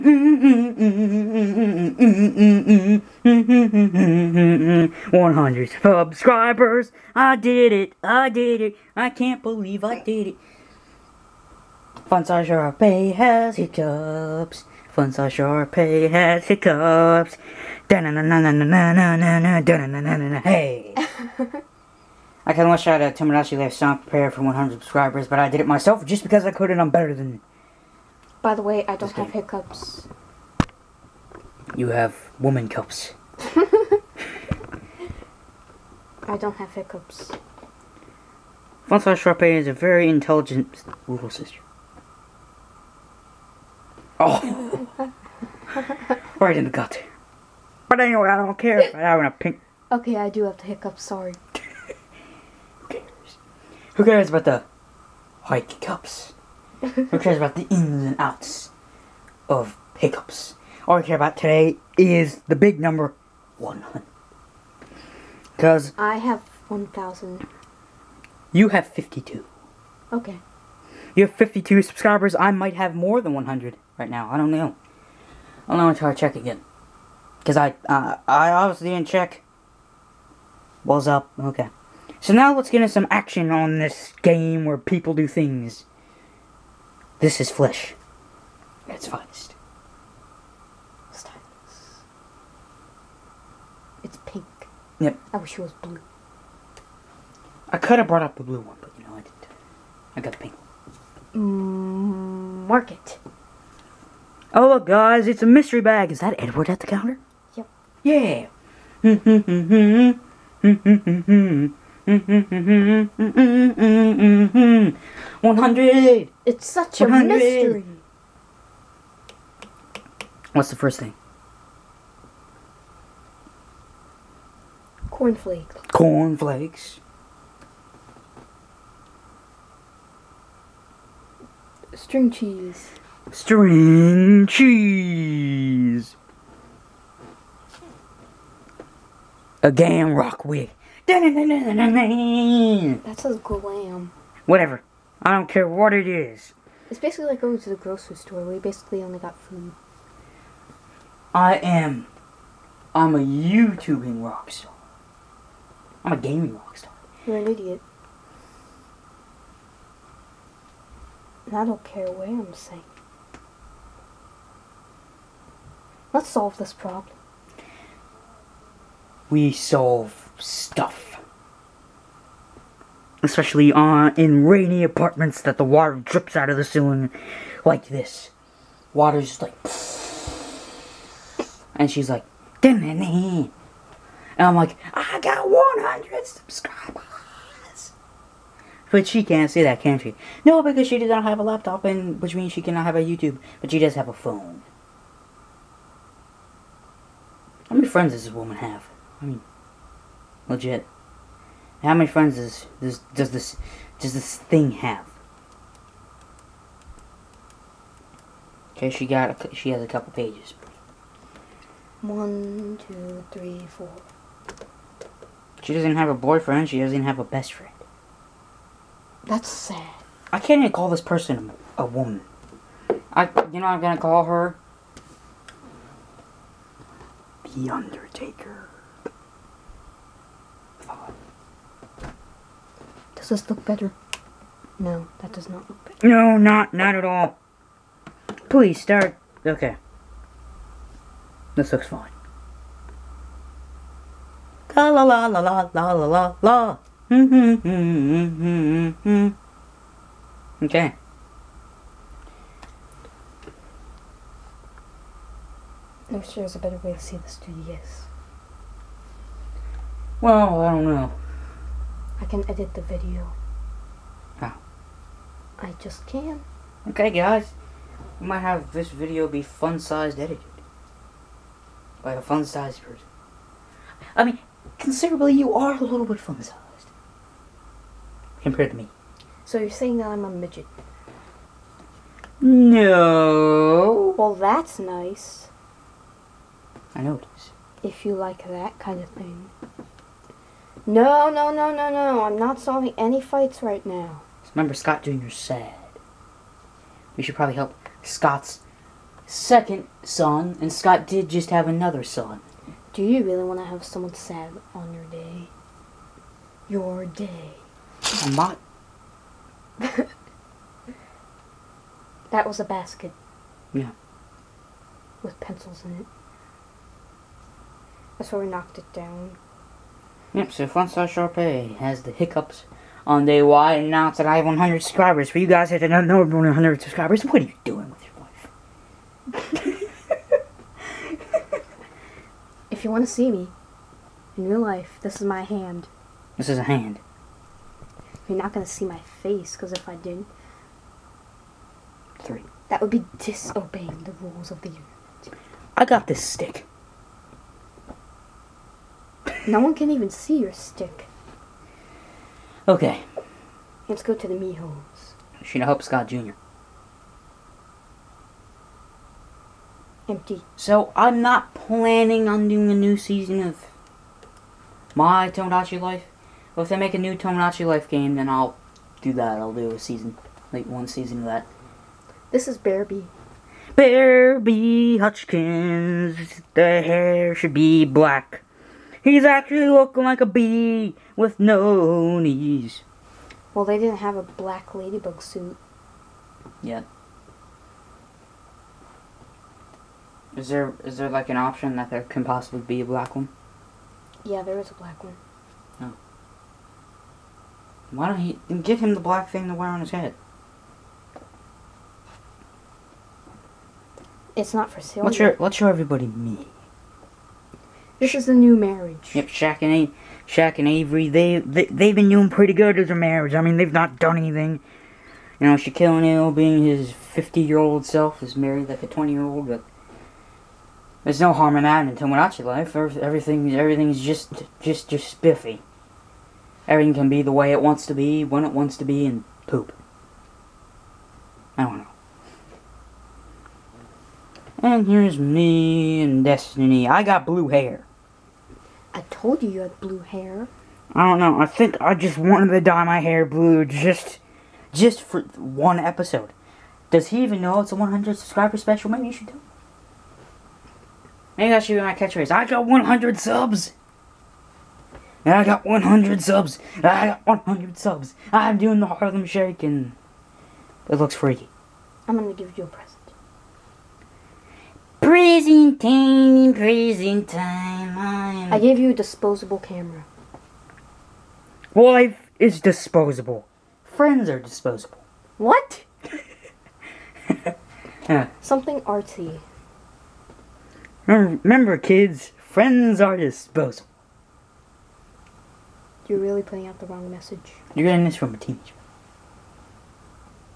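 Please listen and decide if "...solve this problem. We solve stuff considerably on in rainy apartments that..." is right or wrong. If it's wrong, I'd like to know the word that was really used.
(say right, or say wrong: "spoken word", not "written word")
wrong: "especially", not "considerably".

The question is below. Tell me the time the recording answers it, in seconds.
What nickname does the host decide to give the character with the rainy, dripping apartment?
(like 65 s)
227 s.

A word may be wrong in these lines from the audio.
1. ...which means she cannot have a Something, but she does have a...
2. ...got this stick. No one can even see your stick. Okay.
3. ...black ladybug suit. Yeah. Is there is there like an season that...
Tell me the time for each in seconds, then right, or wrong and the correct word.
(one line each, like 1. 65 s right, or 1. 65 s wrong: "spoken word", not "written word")
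1. 192 s wrong: "YouTube", not "Something"
2. 345 s right
3. 384 s wrong: "option", not "season".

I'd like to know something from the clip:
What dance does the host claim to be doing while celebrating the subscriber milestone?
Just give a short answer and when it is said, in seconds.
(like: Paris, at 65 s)
The Harlem Shake, at 458 s.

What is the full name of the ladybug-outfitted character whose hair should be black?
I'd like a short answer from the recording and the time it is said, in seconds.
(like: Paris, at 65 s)
Bearby Hutchkins, at 373 s.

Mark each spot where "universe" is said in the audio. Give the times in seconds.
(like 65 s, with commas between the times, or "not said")
344 s.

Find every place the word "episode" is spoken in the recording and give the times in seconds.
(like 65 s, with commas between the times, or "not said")
445 s.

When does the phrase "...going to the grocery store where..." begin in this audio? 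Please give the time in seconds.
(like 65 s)
147 s.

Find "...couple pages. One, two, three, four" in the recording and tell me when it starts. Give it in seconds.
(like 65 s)
209 s.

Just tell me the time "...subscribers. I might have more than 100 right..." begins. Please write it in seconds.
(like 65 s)
71 s.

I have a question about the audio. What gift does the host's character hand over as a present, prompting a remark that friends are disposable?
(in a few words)
A disposable camera.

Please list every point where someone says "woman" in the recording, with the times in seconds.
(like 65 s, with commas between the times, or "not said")
32 s, 198 s, 221 s.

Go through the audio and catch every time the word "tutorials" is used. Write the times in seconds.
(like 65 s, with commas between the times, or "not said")
not said.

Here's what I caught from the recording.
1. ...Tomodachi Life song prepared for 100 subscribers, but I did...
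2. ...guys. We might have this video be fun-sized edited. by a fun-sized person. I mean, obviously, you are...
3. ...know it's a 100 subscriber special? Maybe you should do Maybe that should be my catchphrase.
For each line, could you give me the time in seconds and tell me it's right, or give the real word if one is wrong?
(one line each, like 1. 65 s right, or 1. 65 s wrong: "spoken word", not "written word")
1. 23 s right
2. 267 s wrong: "considerably", not "obviously"
3. 447 s right.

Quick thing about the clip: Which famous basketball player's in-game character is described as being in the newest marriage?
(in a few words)
Shaquille O'Neal.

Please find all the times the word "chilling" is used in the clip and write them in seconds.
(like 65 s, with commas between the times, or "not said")
not said.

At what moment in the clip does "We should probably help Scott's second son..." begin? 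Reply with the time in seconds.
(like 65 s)
297 s.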